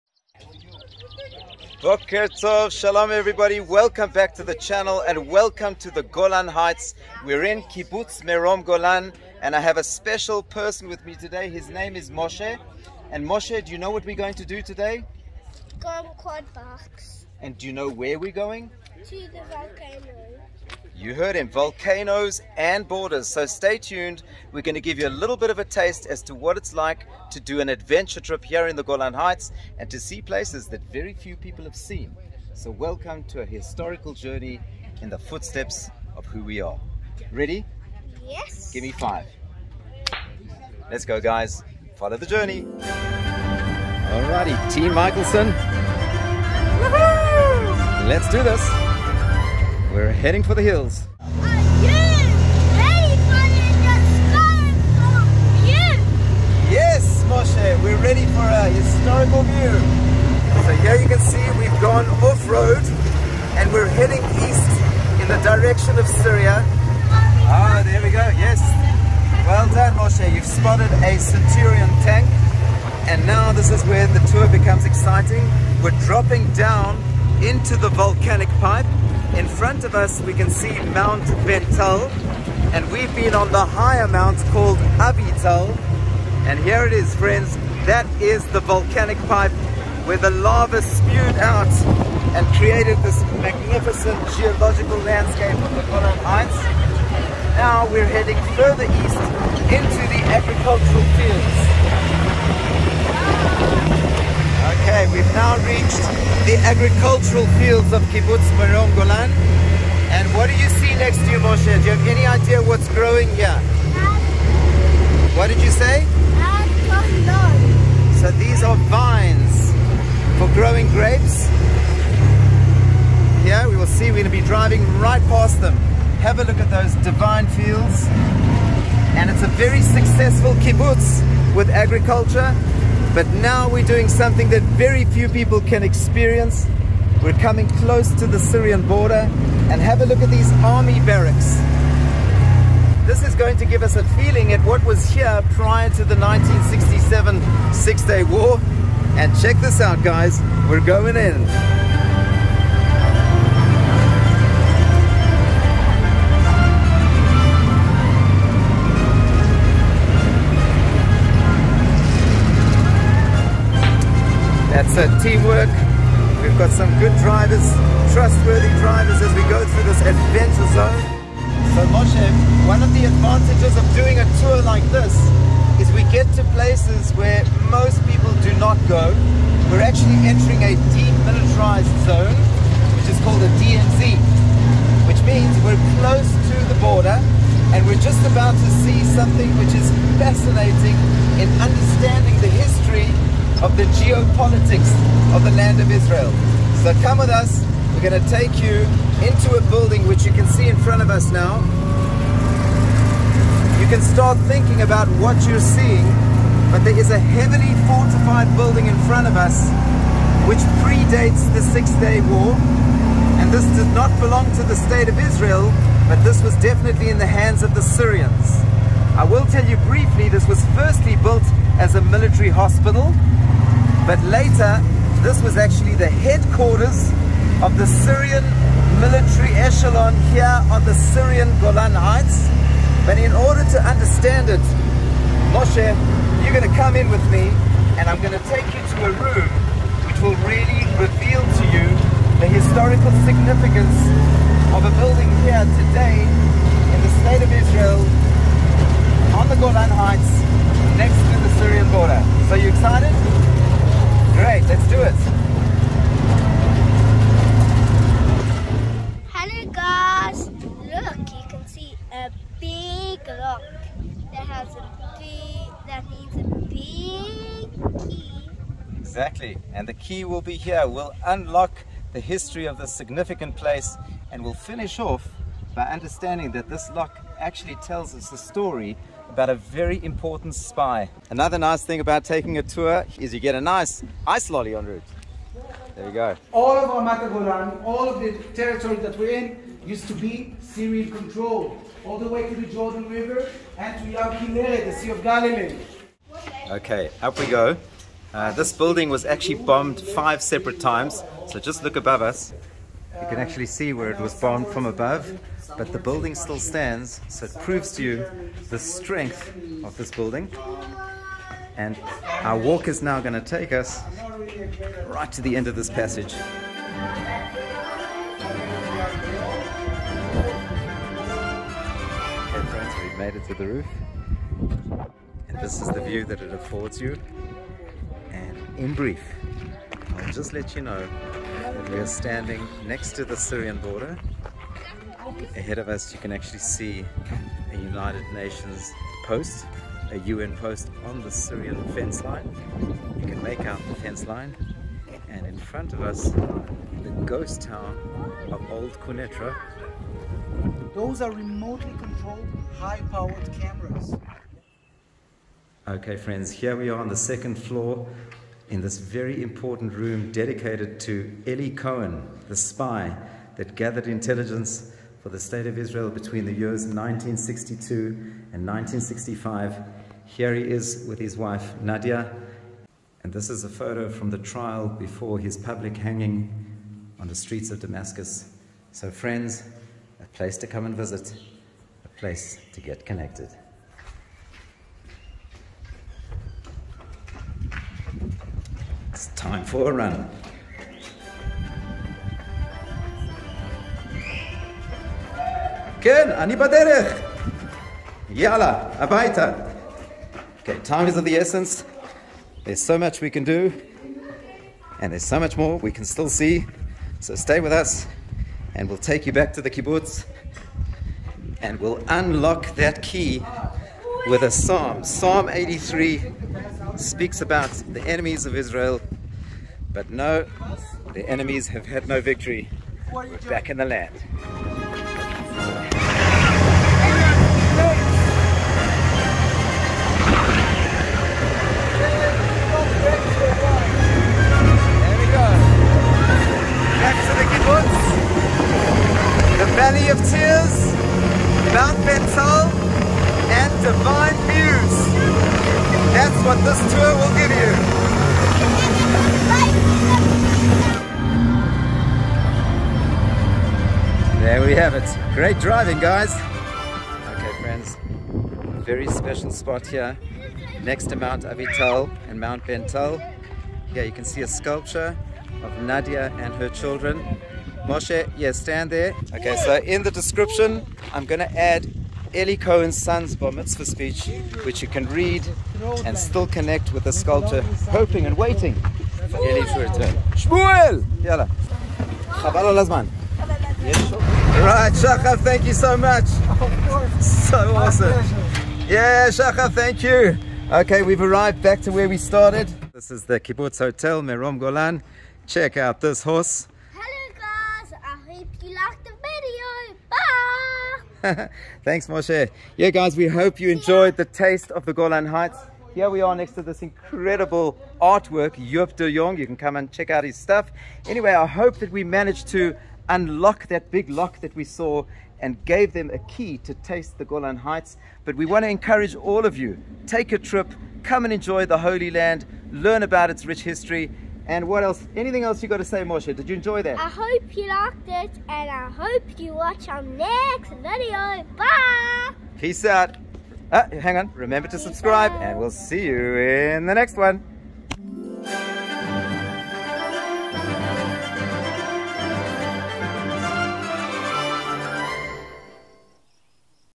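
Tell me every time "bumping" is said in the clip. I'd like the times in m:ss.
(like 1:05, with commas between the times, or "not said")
not said.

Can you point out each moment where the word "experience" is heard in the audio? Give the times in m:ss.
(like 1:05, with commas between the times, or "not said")
2:15.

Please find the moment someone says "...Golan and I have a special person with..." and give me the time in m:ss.
0:08.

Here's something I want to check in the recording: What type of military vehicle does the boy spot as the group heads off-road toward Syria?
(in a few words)
Centurion tank.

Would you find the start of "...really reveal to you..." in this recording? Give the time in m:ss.
4:00.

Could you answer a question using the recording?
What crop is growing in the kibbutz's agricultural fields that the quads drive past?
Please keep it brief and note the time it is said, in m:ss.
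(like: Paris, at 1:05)
Grapes, at 2:00.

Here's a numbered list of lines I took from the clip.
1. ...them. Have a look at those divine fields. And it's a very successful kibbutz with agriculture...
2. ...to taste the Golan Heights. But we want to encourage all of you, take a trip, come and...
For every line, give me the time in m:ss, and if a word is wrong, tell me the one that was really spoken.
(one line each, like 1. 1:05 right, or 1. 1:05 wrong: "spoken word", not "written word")
1. 2:05 right
2. 8:36 right.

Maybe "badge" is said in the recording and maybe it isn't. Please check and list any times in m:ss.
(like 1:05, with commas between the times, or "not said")
not said.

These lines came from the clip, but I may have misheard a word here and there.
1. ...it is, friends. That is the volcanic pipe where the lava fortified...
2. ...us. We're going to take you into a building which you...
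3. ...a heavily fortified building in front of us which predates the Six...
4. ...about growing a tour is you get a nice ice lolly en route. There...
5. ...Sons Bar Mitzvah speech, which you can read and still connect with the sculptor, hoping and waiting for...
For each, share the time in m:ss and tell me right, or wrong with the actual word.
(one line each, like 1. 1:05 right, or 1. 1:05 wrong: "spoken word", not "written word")
1. 1:26 wrong: "spewed", not "fortified"
2. 3:17 right
3. 3:27 right
4. 4:42 wrong: "taking", not "growing"
5. 7:52 right.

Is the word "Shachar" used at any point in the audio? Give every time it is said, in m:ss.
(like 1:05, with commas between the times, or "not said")
8:04, 8:09.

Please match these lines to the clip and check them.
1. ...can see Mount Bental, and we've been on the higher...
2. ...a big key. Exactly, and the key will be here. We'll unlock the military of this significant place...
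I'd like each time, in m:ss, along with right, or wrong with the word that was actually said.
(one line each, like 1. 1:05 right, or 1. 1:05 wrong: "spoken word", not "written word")
1. 1:20 right
2. 4:26 wrong: "history", not "military".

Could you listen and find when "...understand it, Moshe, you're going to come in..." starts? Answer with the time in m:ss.
3:53.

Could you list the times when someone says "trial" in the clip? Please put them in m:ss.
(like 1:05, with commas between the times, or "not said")
6:14.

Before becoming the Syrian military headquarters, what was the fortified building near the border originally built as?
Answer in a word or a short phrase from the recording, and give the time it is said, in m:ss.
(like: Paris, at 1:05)
Military hospital, at 3:42.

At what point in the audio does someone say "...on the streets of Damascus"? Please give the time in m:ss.
6:17.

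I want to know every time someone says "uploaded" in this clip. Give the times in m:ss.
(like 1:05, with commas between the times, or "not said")
not said.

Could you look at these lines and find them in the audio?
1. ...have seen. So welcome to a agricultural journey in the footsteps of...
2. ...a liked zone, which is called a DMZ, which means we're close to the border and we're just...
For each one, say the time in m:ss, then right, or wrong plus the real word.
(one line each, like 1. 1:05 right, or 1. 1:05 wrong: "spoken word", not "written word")
1. 0:31 wrong: "historical", not "agricultural"
2. 3:00 wrong: "demilitarized", not "liked".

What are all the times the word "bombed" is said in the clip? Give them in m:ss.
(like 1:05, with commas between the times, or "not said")
4:59, 5:04.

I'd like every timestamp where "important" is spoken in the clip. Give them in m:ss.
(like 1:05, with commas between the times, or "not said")
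4:40, 5:59.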